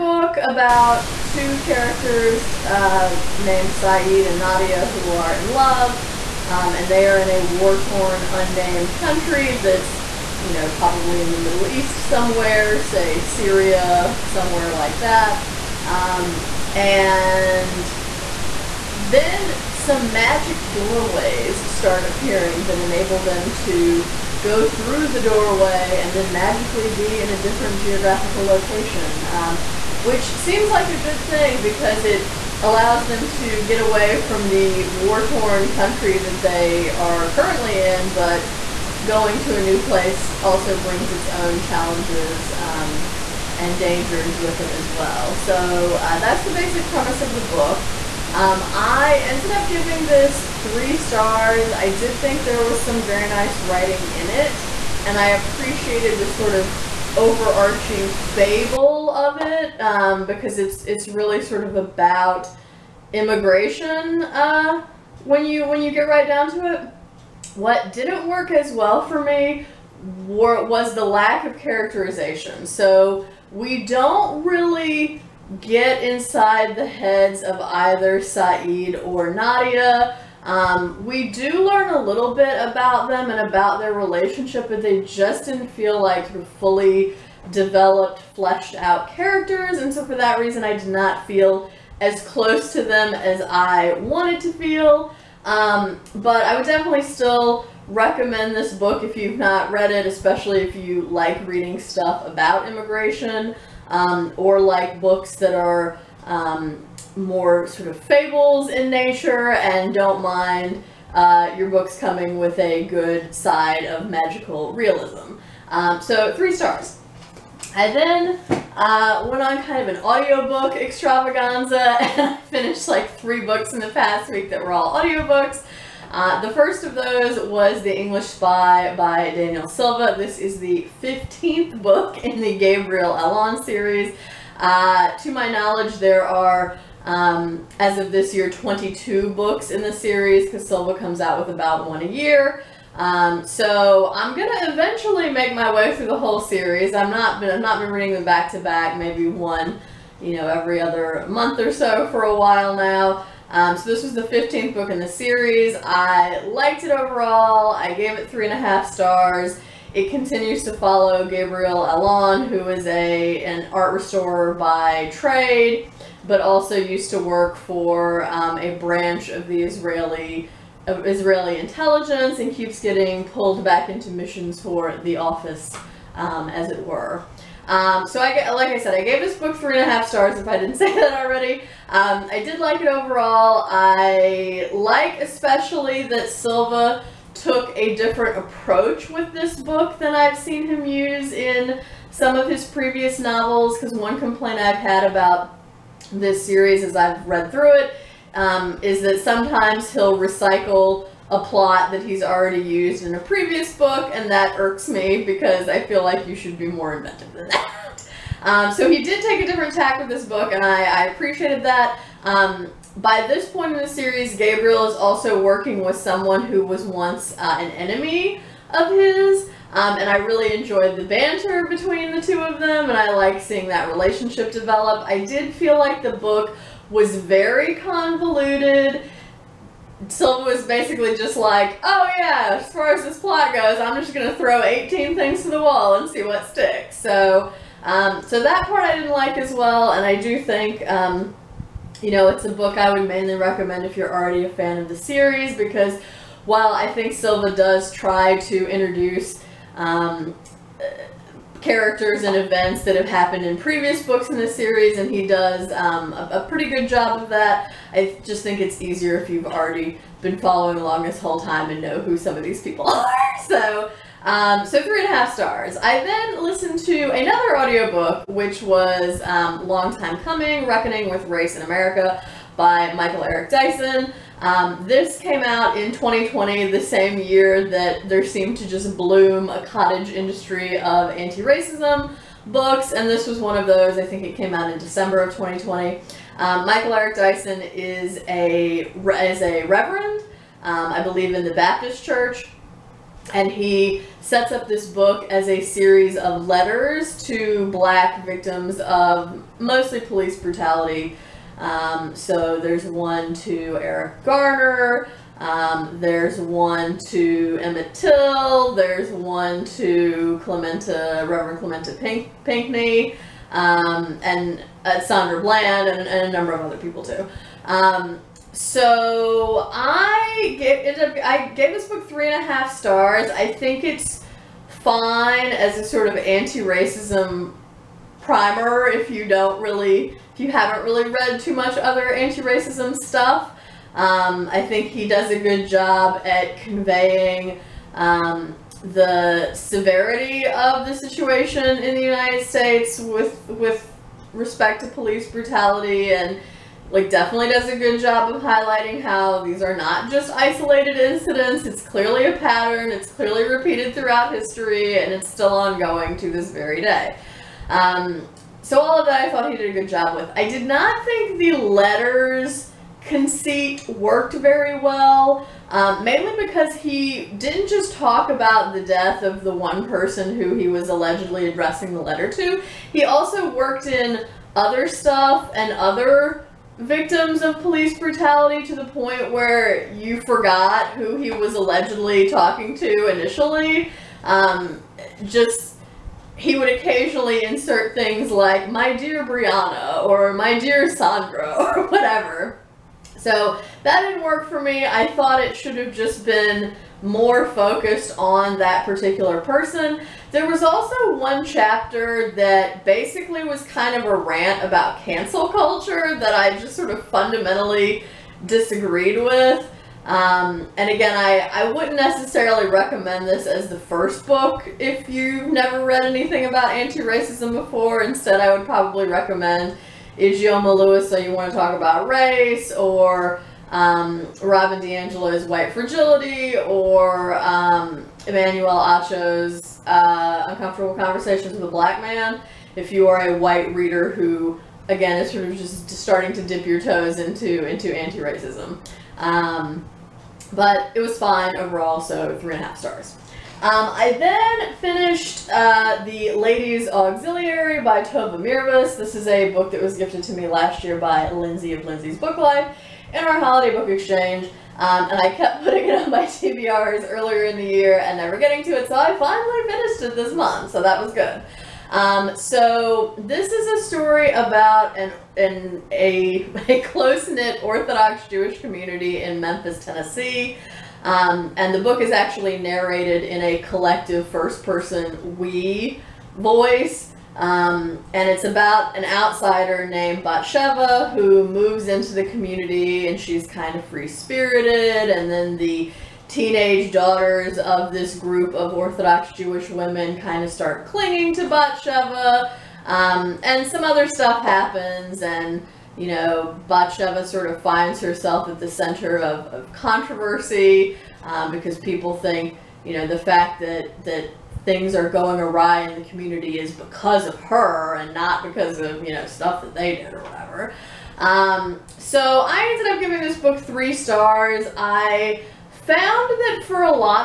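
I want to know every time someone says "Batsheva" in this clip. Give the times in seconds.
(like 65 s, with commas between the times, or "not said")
480 s, 491 s, 496 s.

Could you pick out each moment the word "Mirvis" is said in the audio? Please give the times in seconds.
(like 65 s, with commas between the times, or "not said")
448 s.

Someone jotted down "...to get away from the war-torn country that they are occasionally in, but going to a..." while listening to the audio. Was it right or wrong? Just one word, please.
wrong.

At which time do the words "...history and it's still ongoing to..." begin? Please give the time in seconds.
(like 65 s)
354 s.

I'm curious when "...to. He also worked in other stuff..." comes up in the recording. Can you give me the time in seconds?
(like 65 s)
372 s.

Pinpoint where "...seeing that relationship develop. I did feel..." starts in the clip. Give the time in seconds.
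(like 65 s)
223 s.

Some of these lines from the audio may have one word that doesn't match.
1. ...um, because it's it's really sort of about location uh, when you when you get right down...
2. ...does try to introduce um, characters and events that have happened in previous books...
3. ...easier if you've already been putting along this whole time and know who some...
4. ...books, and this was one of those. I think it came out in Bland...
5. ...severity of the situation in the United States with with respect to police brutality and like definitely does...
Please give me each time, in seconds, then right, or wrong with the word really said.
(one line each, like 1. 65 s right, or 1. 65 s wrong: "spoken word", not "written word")
1. 59 s wrong: "immigration", not "location"
2. 247 s right
3. 258 s wrong: "following", not "putting"
4. 282 s wrong: "December", not "Bland"
5. 339 s right.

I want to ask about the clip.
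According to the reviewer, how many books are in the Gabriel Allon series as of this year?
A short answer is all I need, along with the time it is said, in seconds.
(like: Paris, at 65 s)
22, at 138 s.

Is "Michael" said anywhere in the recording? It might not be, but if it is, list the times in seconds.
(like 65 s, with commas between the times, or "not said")
272 s, 286 s.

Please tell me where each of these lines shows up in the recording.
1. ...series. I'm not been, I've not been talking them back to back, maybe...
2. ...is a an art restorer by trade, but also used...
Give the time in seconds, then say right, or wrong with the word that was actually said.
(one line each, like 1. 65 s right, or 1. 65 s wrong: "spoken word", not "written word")
1. 146 s wrong: "reading", not "talking"
2. 162 s right.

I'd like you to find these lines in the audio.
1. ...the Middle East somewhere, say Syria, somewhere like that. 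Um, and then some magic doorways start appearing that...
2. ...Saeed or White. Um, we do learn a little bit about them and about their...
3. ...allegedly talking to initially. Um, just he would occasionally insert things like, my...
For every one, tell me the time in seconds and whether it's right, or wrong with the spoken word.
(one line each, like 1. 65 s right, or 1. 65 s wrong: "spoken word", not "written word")
1. 11 s right
2. 78 s wrong: "Nadia", not "White"
3. 381 s right.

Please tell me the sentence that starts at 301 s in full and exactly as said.
Um, so there's one to Eric Garner.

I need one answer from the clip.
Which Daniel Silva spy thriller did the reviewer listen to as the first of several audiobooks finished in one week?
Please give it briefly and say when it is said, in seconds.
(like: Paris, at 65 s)
The English Spy, at 127 s.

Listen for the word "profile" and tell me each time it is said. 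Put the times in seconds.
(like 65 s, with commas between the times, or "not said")
not said.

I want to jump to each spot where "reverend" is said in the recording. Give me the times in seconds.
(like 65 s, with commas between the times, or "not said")
289 s, 311 s.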